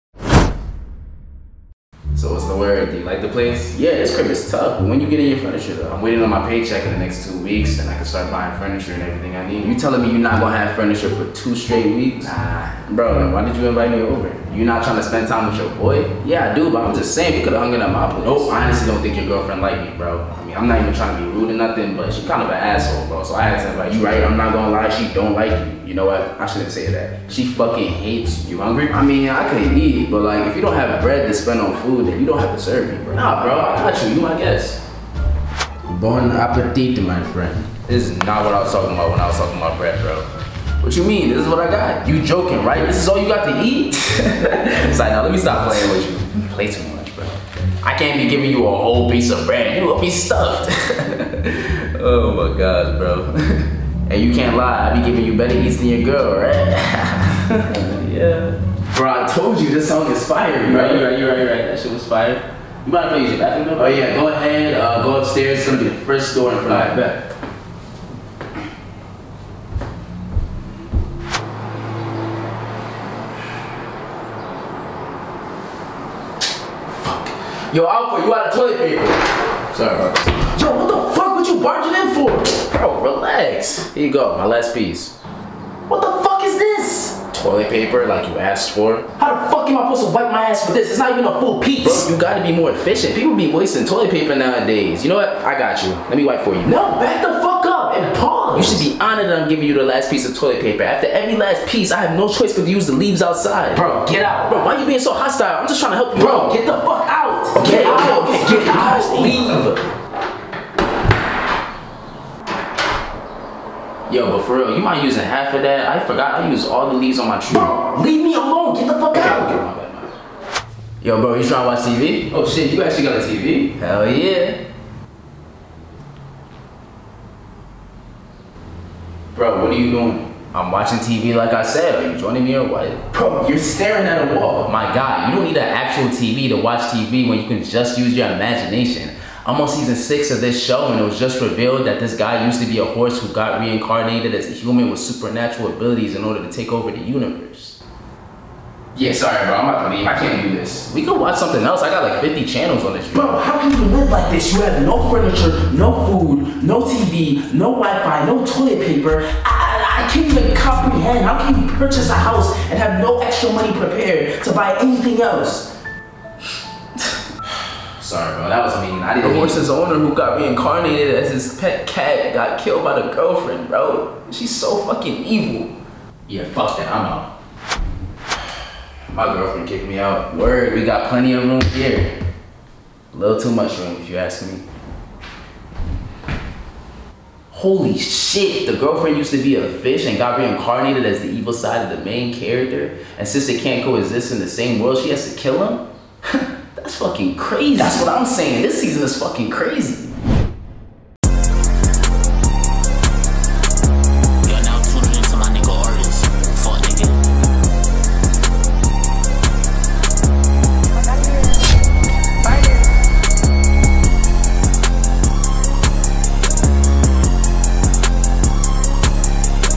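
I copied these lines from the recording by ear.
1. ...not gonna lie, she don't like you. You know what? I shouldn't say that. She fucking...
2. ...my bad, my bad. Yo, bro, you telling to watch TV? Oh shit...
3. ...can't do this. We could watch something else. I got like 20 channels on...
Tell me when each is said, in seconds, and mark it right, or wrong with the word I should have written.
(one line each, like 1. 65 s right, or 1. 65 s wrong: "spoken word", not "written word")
1. 24 s right
2. 119 s wrong: "trying", not "telling"
3. 150 s wrong: "50", not "20".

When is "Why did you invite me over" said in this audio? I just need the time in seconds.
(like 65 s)
13 s.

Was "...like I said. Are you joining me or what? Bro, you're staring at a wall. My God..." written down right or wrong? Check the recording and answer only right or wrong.
right.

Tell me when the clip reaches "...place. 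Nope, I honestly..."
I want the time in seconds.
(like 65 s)
18 s.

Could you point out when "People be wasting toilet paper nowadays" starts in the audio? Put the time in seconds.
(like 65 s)
93 s.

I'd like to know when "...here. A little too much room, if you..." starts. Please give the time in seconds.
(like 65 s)
181 s.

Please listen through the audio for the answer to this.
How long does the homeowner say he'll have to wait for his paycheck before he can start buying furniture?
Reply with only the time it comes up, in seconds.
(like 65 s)
7 s.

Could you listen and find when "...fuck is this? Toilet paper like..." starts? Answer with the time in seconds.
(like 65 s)
86 s.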